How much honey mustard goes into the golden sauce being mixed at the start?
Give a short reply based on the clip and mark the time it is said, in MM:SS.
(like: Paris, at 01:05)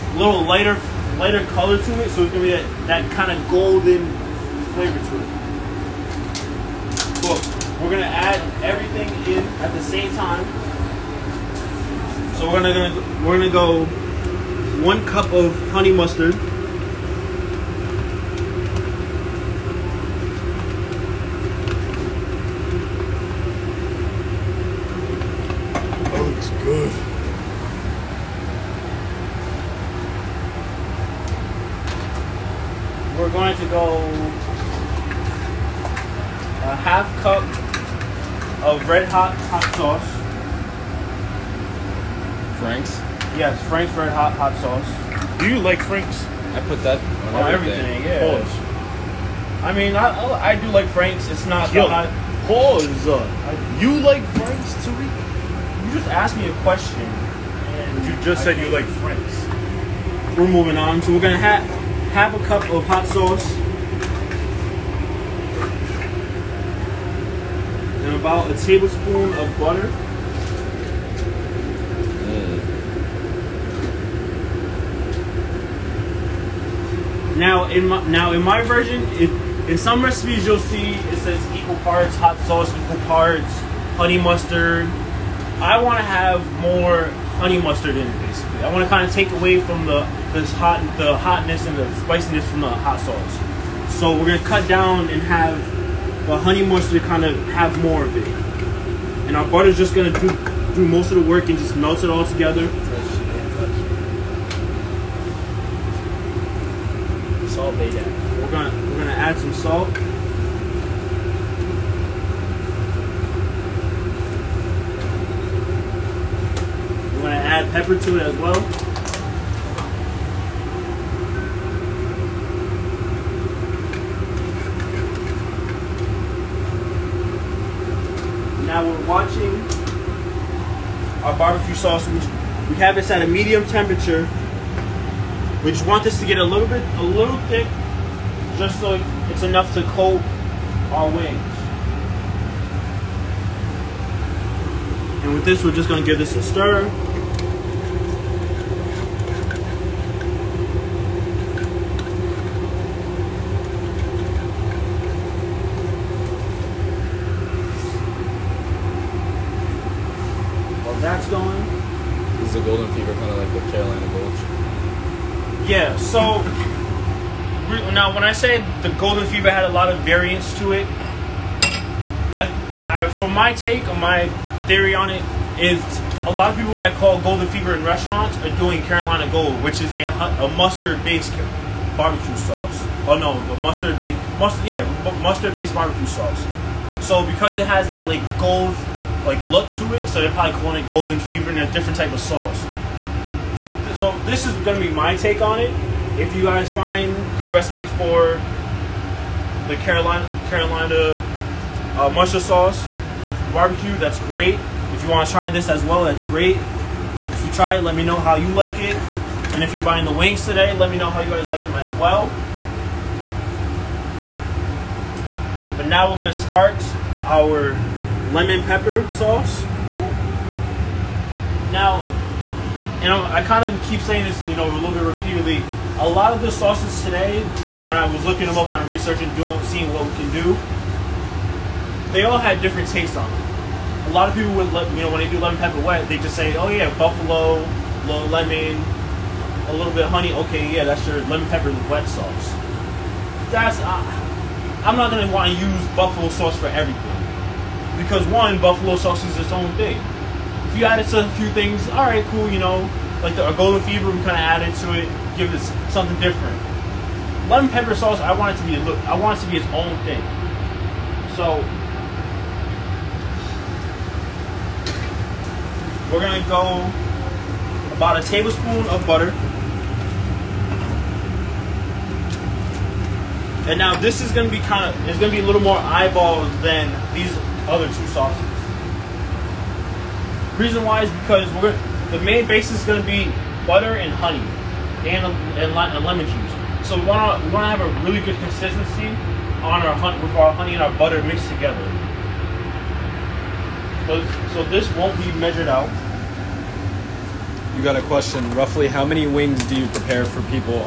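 1 cup, at 00:14.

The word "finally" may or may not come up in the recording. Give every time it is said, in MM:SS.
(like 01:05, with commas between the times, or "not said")
not said.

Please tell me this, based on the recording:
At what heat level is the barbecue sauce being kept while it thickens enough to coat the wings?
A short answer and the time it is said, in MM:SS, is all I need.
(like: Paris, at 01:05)
medium, at 02:13.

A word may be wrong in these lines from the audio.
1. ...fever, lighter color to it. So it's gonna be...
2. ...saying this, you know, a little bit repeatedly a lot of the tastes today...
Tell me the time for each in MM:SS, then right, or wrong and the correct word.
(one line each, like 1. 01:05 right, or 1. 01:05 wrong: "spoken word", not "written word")
1. 00:00 wrong: "lighter", not "fever"
2. 03:44 wrong: "sauces", not "tastes".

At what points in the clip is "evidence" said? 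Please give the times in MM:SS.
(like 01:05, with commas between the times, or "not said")
not said.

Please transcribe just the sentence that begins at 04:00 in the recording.
Okay, yeah, that's your lemon pepper wet sauce.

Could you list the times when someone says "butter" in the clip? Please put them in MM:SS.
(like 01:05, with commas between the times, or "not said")
01:09, 01:39, 04:29, 04:43, 04:50.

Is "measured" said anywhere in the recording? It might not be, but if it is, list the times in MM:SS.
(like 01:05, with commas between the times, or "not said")
04:55.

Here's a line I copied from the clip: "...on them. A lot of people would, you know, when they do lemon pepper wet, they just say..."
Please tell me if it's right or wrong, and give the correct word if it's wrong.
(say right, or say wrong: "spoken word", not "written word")
right.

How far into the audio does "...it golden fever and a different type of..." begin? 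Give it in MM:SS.
03:10.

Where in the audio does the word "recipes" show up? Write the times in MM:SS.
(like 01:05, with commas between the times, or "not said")
01:20, 03:17.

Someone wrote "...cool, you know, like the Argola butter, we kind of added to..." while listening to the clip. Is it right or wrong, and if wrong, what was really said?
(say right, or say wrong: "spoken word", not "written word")
wrong: "fever", not "butter".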